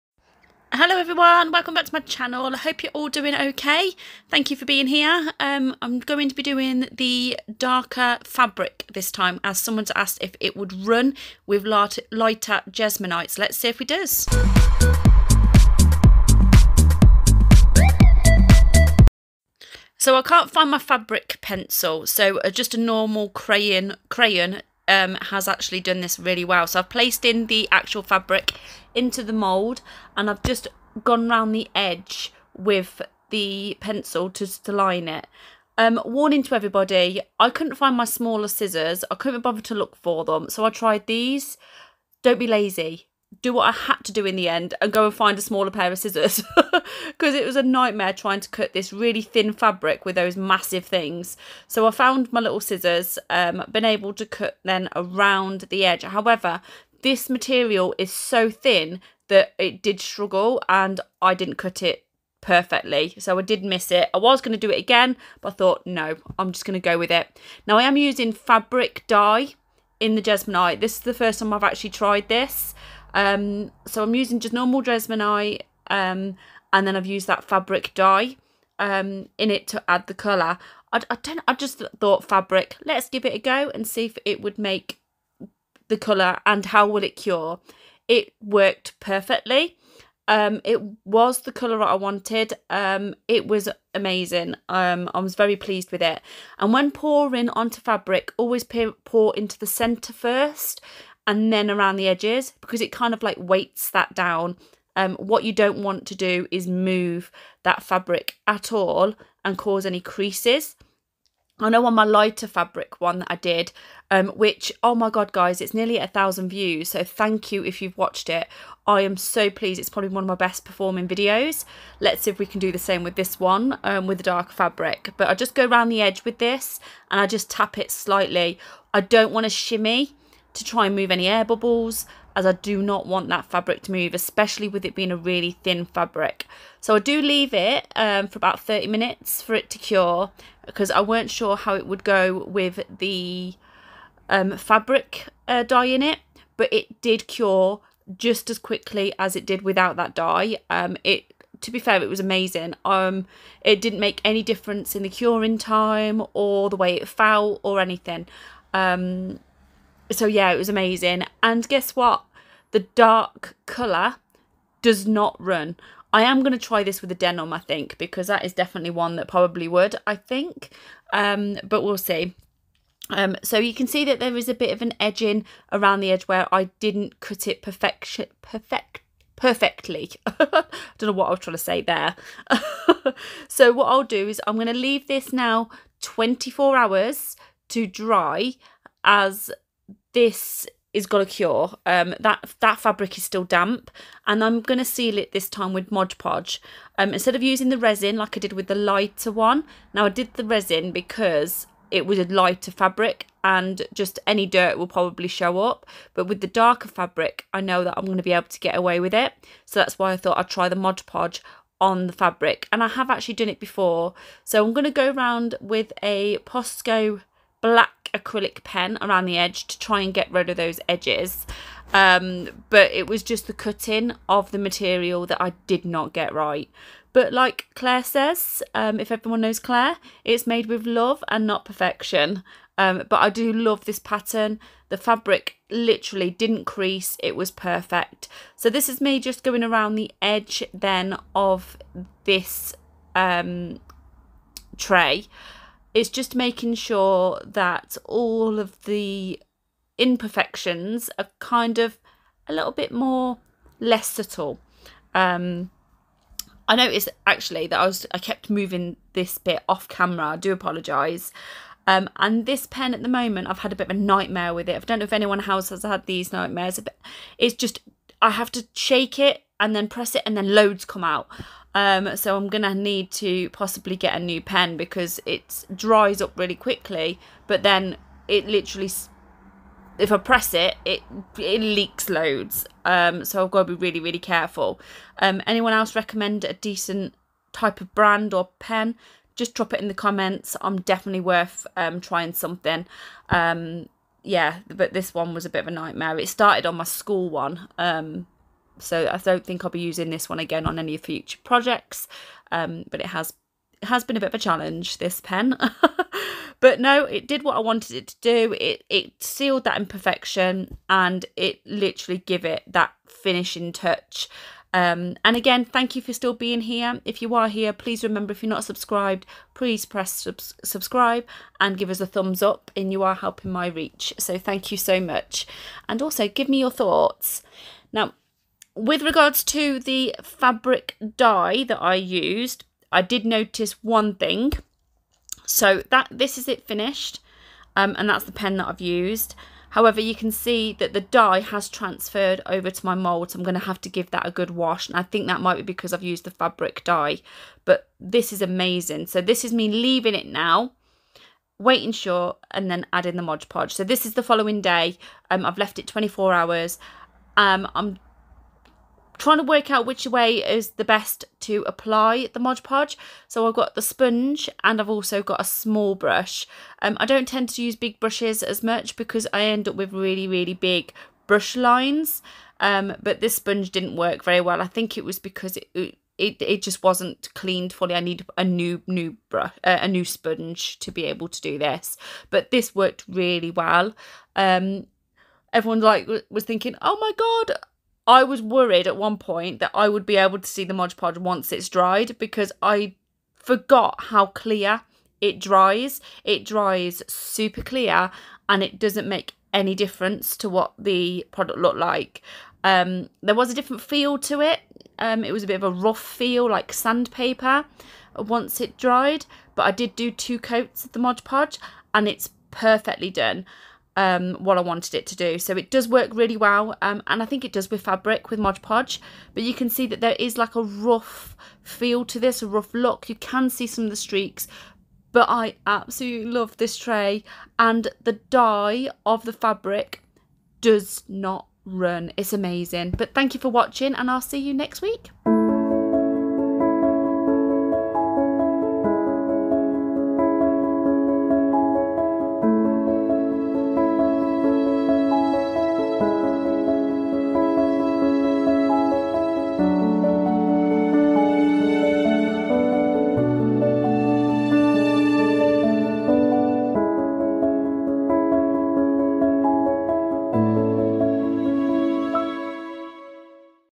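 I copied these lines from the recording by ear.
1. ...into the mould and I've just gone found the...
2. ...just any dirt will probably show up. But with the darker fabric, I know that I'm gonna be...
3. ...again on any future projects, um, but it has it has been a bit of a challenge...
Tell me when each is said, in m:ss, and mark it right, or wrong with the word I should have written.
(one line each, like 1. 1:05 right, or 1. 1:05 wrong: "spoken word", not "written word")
1. 0:28 wrong: "round", not "found"
2. 3:23 right
3. 5:00 right.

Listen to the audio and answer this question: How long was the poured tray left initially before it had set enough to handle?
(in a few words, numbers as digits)
30 minutes.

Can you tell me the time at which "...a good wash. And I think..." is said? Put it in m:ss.
5:44.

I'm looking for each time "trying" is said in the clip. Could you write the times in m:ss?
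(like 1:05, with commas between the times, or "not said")
0:48, 3:01, 4:52, 5:59.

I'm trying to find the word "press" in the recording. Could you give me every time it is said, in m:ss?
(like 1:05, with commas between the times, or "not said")
4:29, 4:40, 5:19.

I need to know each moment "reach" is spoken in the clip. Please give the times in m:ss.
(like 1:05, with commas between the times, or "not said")
5:23.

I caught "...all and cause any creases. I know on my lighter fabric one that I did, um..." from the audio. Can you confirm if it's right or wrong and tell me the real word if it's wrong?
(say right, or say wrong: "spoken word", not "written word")
right.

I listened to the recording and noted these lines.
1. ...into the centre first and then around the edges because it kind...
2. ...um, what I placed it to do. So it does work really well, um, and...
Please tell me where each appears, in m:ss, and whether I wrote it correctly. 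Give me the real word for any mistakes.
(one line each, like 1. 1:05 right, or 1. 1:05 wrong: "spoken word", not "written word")
1. 1:39 right
2. 6:54 wrong: "wanted", not "placed".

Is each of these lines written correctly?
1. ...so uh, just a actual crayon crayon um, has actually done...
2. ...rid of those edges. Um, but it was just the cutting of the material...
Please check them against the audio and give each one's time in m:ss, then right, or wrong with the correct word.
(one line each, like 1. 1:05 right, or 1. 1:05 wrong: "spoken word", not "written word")
1. 0:22 wrong: "normal", not "actual"
2. 3:40 right.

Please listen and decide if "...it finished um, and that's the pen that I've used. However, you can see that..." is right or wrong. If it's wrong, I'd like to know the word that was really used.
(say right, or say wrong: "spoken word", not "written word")
right.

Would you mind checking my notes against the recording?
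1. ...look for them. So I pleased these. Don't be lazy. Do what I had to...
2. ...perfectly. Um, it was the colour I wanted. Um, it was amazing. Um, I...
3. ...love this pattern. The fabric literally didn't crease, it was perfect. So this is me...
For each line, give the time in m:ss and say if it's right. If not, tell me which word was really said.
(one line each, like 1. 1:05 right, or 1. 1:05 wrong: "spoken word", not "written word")
1. 0:39 wrong: "tried", not "pleased"
2. 1:28 right
3. 3:53 right.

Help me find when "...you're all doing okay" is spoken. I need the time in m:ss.
0:02.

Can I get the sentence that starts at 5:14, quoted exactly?
Um, and again, thank you for still being here.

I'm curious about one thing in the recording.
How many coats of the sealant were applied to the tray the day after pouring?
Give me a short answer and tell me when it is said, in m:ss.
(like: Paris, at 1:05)
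2, at 6:50.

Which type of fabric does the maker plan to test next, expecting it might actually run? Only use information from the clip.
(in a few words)
denim.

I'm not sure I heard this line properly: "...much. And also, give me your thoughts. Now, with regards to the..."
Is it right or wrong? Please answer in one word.
right.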